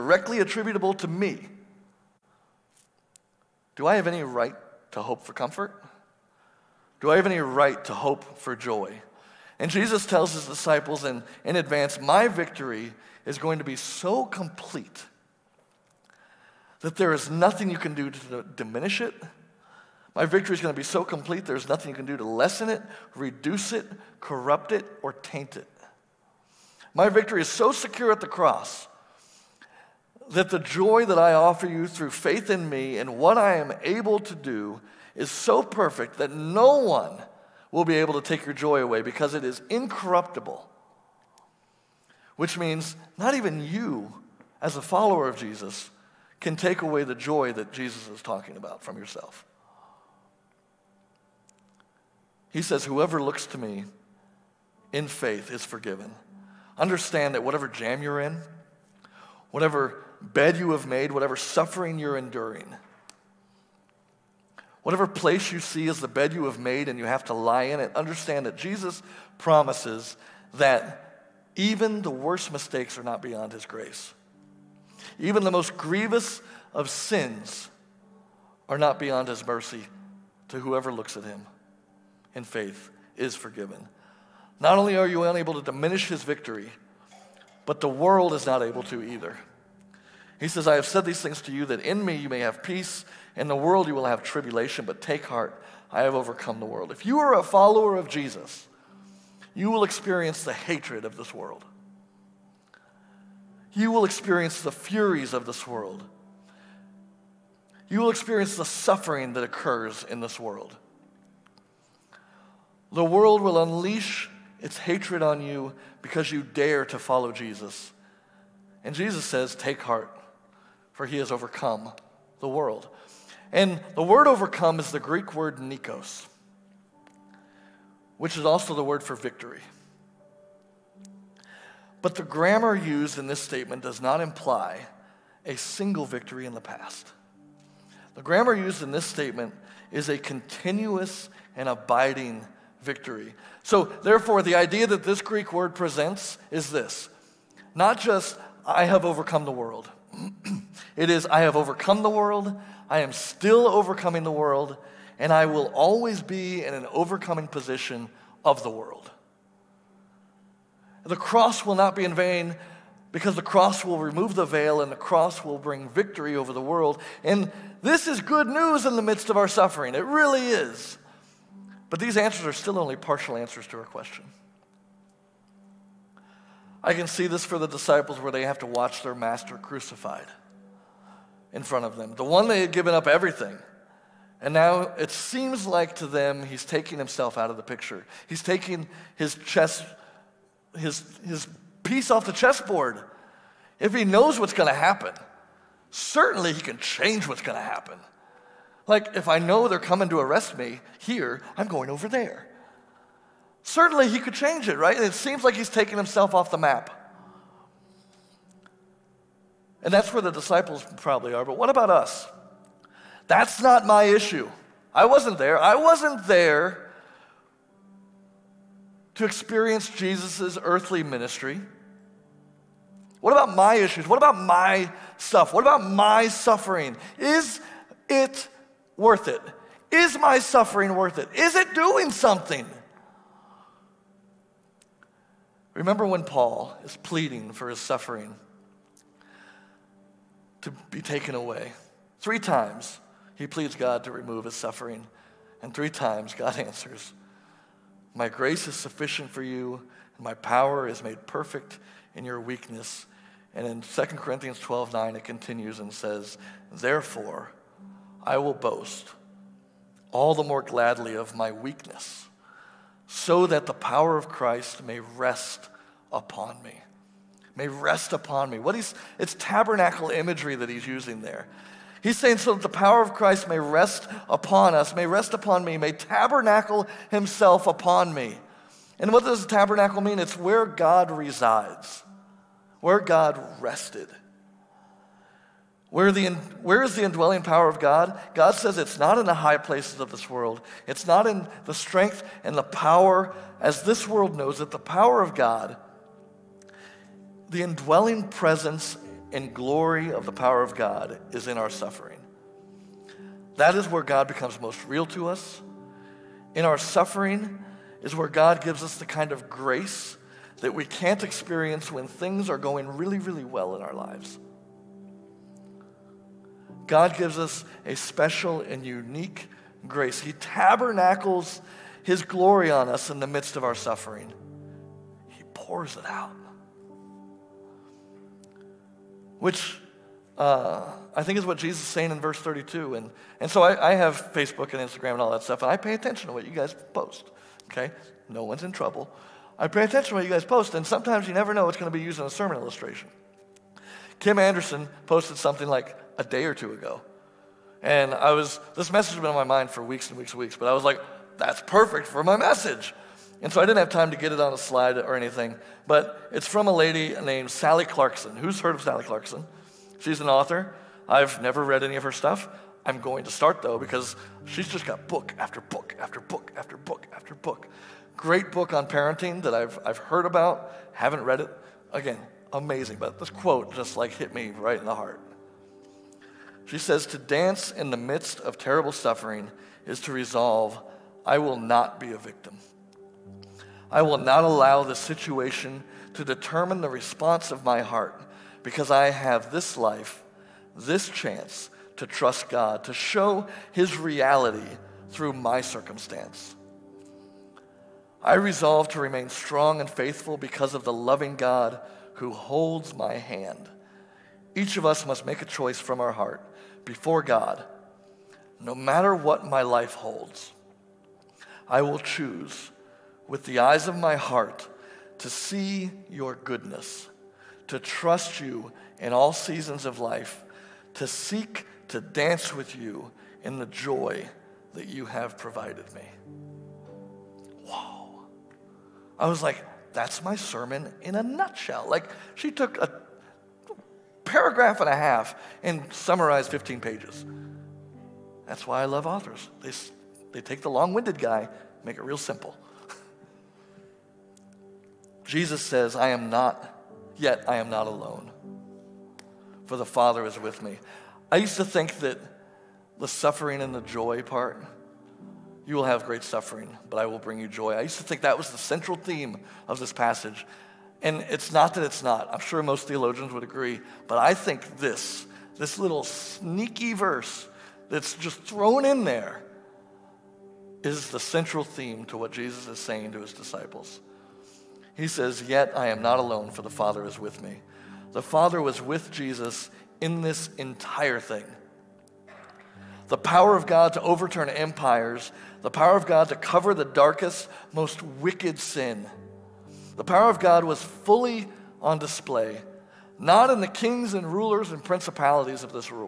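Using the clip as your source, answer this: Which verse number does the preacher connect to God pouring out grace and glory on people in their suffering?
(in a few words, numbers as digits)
32.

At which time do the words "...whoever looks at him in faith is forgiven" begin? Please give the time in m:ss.
1:20.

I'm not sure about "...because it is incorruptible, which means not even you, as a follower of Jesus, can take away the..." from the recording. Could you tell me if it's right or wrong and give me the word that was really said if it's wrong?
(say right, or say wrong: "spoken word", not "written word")
right.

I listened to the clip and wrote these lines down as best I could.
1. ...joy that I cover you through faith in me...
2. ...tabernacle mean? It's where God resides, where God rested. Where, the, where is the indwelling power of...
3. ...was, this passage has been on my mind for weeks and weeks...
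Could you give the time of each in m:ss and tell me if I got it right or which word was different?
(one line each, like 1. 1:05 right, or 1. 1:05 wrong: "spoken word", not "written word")
1. 0:30 wrong: "offer", not "cover"
2. 4:39 right
3. 5:48 wrong: "message", not "passage".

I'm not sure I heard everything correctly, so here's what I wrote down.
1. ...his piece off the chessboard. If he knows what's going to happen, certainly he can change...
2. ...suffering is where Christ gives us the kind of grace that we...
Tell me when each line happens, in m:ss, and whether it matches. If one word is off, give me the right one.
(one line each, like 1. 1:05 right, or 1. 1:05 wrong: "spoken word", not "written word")
1. 3:11 right
2. 5:06 wrong: "God", not "Christ".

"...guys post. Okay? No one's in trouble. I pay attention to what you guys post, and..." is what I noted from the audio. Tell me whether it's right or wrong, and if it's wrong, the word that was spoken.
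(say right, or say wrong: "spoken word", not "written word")
right.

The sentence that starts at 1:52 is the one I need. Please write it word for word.
The world will unleash its hatred on you because you dare to follow Jesus.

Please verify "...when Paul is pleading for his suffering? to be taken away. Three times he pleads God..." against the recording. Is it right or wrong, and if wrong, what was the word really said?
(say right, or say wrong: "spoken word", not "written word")
right.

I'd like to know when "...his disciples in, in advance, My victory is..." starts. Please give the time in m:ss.
0:10.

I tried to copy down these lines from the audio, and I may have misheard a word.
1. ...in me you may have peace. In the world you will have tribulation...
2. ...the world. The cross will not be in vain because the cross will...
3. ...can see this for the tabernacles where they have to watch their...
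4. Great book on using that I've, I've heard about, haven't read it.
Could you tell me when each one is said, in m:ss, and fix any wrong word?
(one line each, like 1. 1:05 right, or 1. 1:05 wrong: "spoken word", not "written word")
1. 1:31 right
2. 2:38 right
3. 2:56 wrong: "disciples", not "tabernacles"
4. 6:08 wrong: "parenting", not "using".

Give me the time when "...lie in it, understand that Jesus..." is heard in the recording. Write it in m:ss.
1:07.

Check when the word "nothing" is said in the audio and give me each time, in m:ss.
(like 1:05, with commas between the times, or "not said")
0:17, 0:21.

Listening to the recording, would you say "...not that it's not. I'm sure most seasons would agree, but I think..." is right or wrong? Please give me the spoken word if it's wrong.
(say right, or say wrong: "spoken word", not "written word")
wrong: "theologians", not "seasons".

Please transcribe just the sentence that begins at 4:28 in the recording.
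What he's, it's tabernacle imagery that he's using there.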